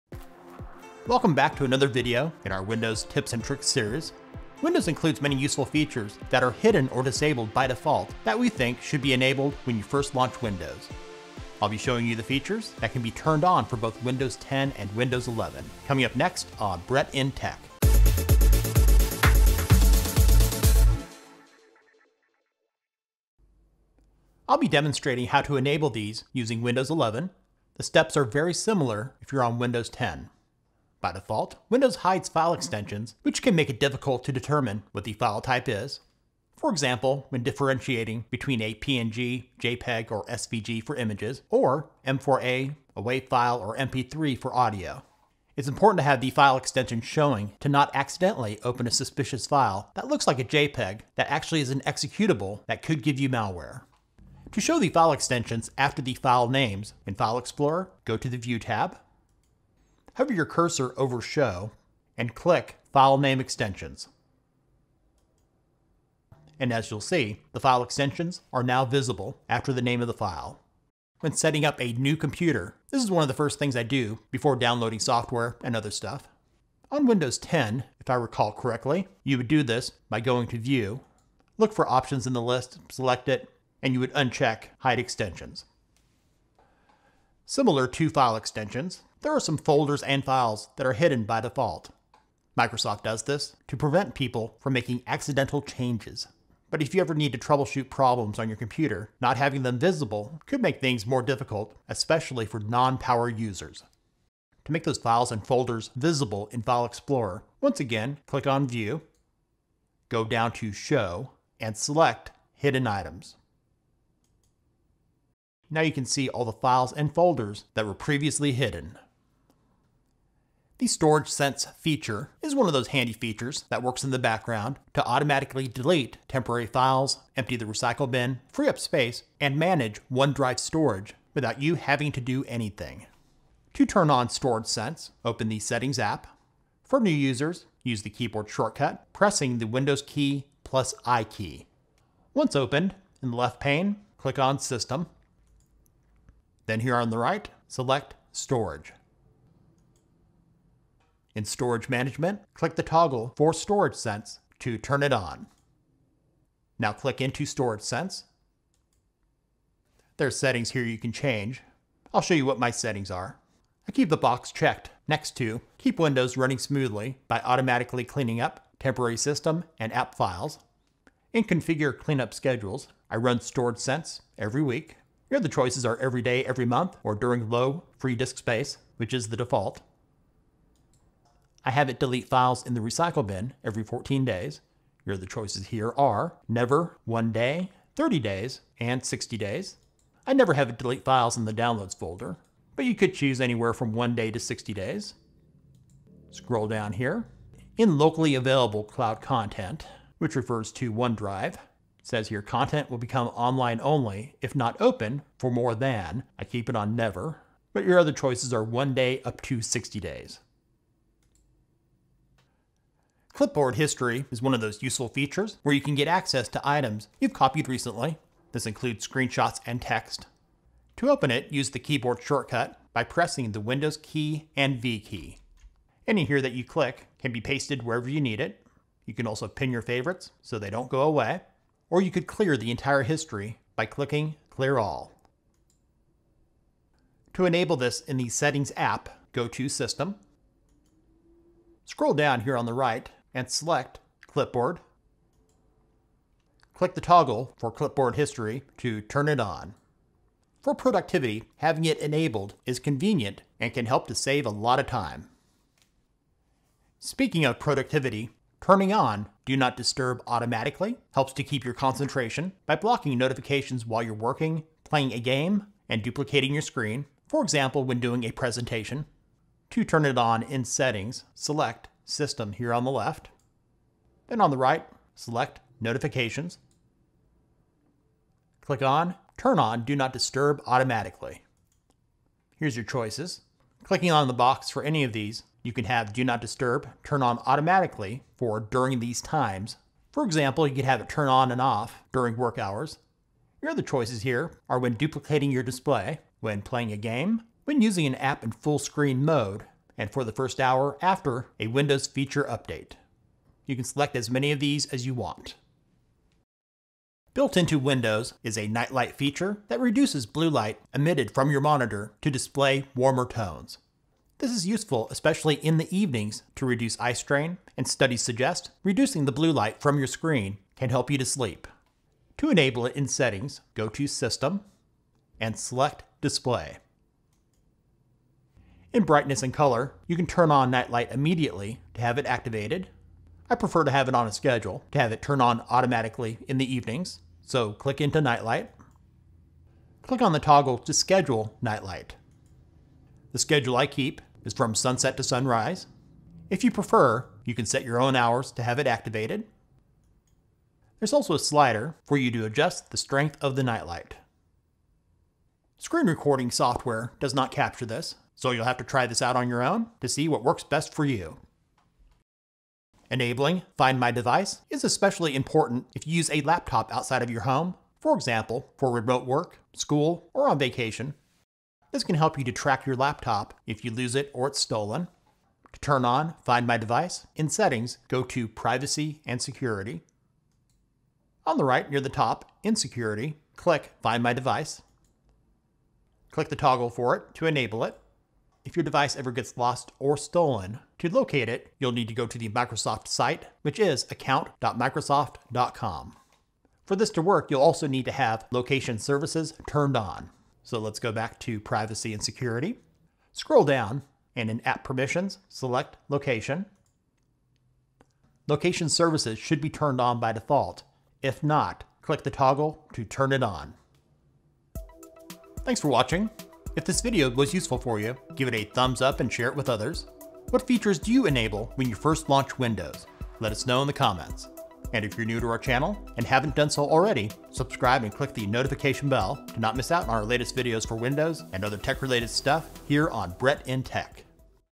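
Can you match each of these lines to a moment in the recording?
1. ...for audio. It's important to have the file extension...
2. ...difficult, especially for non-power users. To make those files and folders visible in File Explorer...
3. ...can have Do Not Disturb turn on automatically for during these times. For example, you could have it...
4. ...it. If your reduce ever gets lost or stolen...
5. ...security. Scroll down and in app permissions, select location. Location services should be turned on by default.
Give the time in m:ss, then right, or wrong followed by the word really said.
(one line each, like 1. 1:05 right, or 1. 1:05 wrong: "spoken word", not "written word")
1. 0:44 right
2. 1:41 right
3. 4:45 right
4. 6:27 wrong: "device", not "reduce"
5. 6:42 right.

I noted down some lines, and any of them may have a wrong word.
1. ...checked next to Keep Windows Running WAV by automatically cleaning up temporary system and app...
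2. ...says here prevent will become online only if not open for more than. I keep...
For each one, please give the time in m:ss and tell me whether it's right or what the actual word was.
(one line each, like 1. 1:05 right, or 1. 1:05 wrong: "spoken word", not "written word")
1. 2:44 wrong: "Smoothly", not "WAV"
2. 3:22 wrong: "content", not "prevent".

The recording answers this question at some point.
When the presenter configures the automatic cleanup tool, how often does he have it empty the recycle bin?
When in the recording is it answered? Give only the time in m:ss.
3:03.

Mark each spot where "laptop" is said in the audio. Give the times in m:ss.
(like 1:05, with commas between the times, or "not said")
6:06, 6:12.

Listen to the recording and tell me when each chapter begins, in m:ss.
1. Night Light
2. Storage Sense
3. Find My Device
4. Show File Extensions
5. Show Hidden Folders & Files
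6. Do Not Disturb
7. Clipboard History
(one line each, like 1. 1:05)
1. 5:06
2. 1:59
3. 6:02
4. 0:23
5. 1:26
6. 4:16
7. 3:32.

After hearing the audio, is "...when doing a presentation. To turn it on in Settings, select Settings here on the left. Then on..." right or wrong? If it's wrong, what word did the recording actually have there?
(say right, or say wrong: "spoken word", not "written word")
wrong: "System", not "Settings".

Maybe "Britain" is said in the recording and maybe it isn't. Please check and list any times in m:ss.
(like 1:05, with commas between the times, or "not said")
not said.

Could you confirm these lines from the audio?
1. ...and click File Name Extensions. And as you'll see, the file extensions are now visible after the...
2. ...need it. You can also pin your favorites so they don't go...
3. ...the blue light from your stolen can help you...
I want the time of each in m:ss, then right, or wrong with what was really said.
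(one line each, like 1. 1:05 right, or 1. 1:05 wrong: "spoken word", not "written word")
1. 1:02 right
2. 3:48 right
3. 5:19 wrong: "screen", not "stolen".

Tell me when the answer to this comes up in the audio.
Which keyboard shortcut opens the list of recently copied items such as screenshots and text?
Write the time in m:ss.
3:43.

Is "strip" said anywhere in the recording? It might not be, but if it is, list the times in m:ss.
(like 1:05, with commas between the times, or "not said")
not said.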